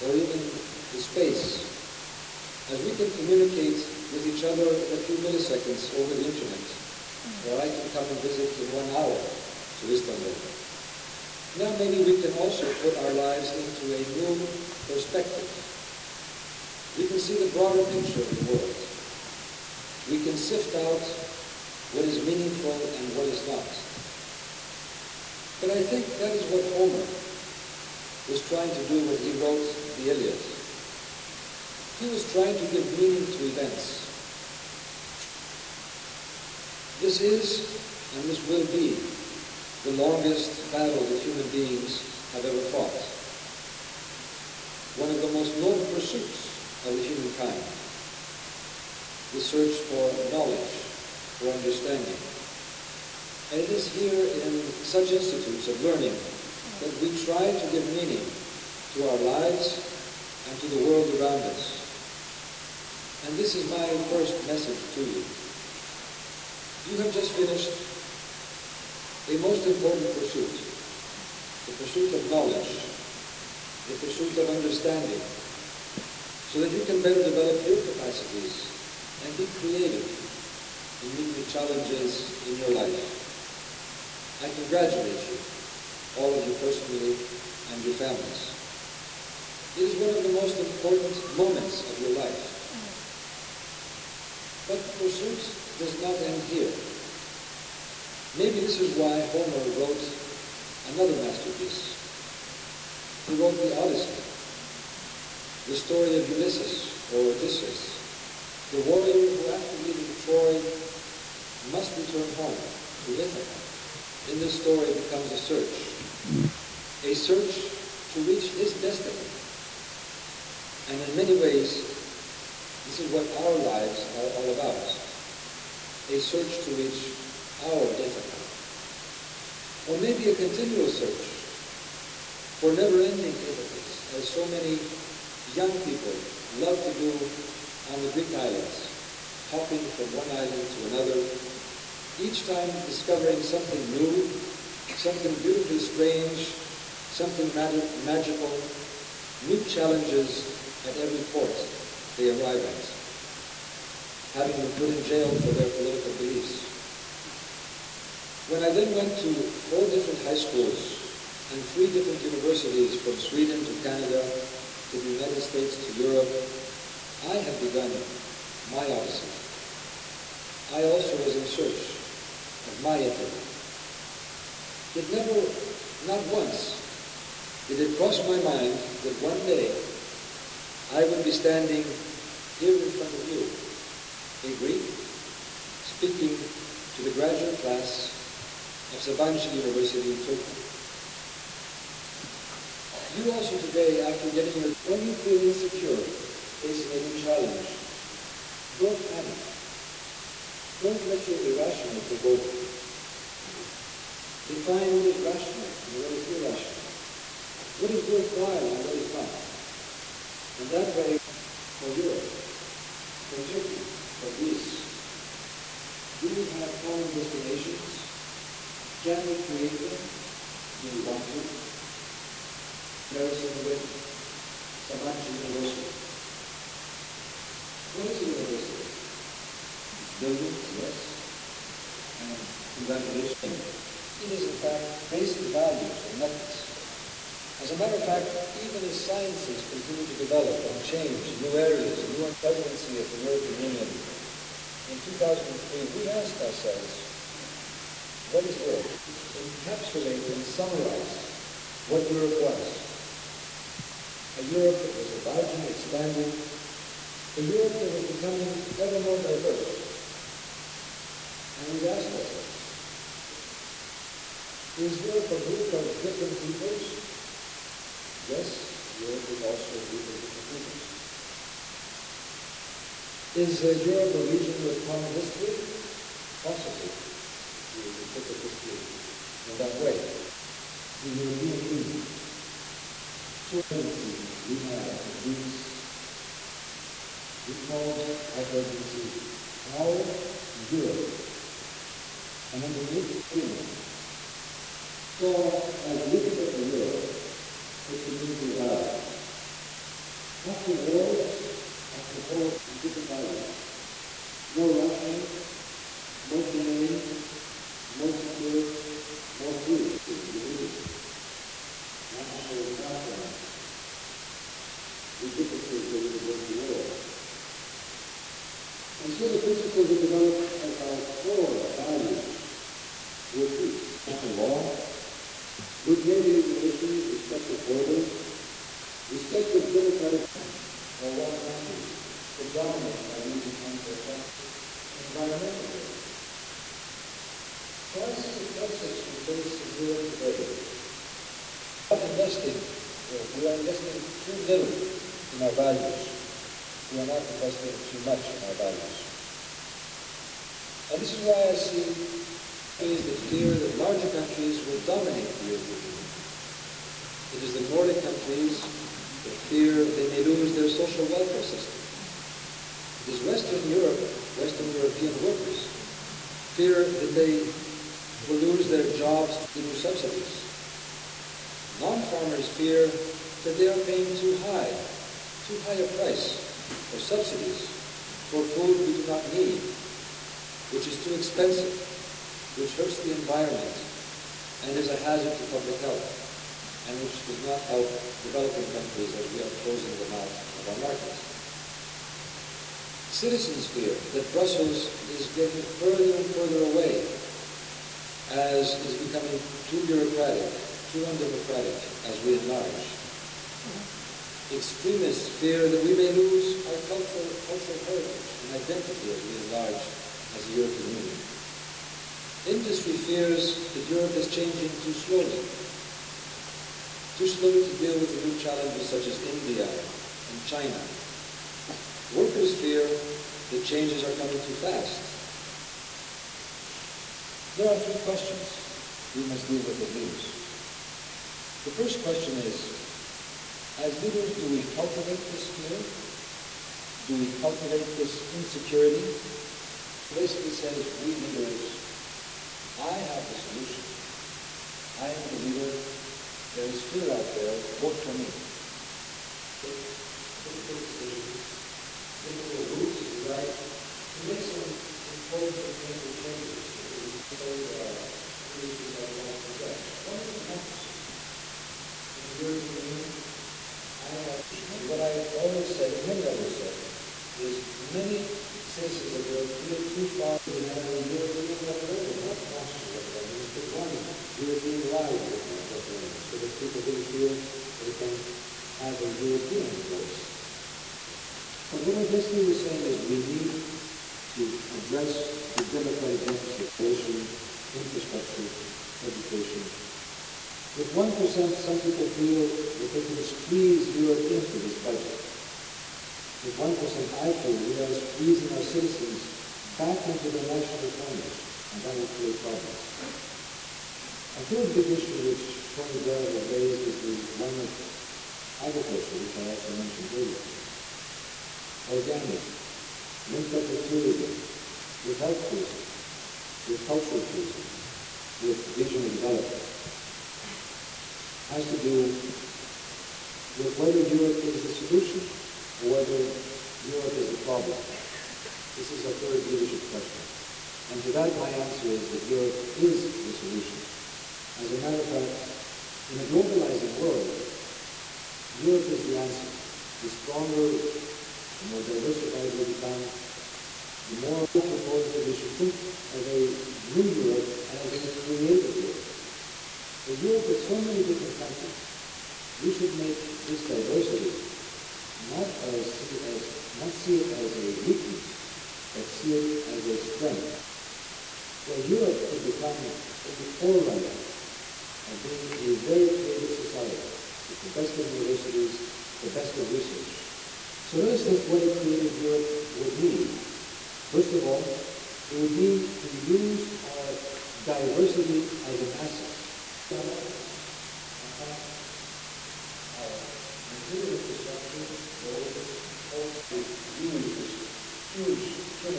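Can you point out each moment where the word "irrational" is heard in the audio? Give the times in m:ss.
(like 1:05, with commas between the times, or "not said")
3:21, 3:26.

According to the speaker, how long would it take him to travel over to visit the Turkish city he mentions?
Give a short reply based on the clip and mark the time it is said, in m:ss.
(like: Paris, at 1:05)
One hour, at 0:08.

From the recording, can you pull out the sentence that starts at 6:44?
Extremists fear that we may lose our cultural, cultural heritage and identity as we enlarge as a European Union.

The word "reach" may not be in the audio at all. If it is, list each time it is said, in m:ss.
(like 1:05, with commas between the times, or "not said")
1:58, 2:06.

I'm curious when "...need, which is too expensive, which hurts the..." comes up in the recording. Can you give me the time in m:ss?
6:19.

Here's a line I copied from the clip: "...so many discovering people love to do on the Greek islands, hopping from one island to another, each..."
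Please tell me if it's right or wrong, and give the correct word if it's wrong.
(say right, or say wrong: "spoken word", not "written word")
wrong: "young", not "discovering".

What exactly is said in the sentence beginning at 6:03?
It is Western Europe, Western European workers, fear that they will lose their jobs to the new subsidies.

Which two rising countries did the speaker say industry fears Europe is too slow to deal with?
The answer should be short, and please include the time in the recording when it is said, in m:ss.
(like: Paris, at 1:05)
India and China, at 6:59.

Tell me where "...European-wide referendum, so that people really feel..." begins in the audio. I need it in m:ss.
7:54.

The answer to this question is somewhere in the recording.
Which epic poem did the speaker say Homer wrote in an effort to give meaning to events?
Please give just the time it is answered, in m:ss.
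0:30.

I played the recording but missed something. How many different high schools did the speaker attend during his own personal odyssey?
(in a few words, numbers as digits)
4.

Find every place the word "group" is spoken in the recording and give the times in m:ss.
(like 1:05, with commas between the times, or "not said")
4:25, 4:29.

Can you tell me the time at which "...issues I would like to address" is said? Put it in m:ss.
7:38.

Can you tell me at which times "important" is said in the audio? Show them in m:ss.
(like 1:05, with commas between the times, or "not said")
1:09, 1:30, 7:35.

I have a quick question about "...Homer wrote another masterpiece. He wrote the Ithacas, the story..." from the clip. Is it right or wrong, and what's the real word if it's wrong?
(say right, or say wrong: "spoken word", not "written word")
wrong: "Odyssey", not "Ithacas".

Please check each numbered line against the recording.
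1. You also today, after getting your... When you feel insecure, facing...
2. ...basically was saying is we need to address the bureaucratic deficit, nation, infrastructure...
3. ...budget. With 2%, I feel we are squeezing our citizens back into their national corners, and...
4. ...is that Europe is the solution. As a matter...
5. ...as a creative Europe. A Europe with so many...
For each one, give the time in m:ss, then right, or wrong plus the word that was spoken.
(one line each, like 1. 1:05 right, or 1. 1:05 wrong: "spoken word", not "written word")
1. 3:13 right
2. 8:02 wrong: "democratic", not "bureaucratic"
3. 8:14 wrong: "1", not "2"
4. 8:51 right
5. 9:07 right.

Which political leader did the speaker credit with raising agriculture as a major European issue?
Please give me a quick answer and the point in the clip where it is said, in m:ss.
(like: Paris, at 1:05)
Tony Blair, at 8:25.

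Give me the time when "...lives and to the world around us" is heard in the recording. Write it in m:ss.
0:59.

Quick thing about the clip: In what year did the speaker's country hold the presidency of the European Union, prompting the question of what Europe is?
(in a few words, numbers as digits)
2003.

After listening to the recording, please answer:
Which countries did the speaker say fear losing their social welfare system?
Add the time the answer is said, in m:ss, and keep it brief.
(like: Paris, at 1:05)
Nordic countries, at 5:57.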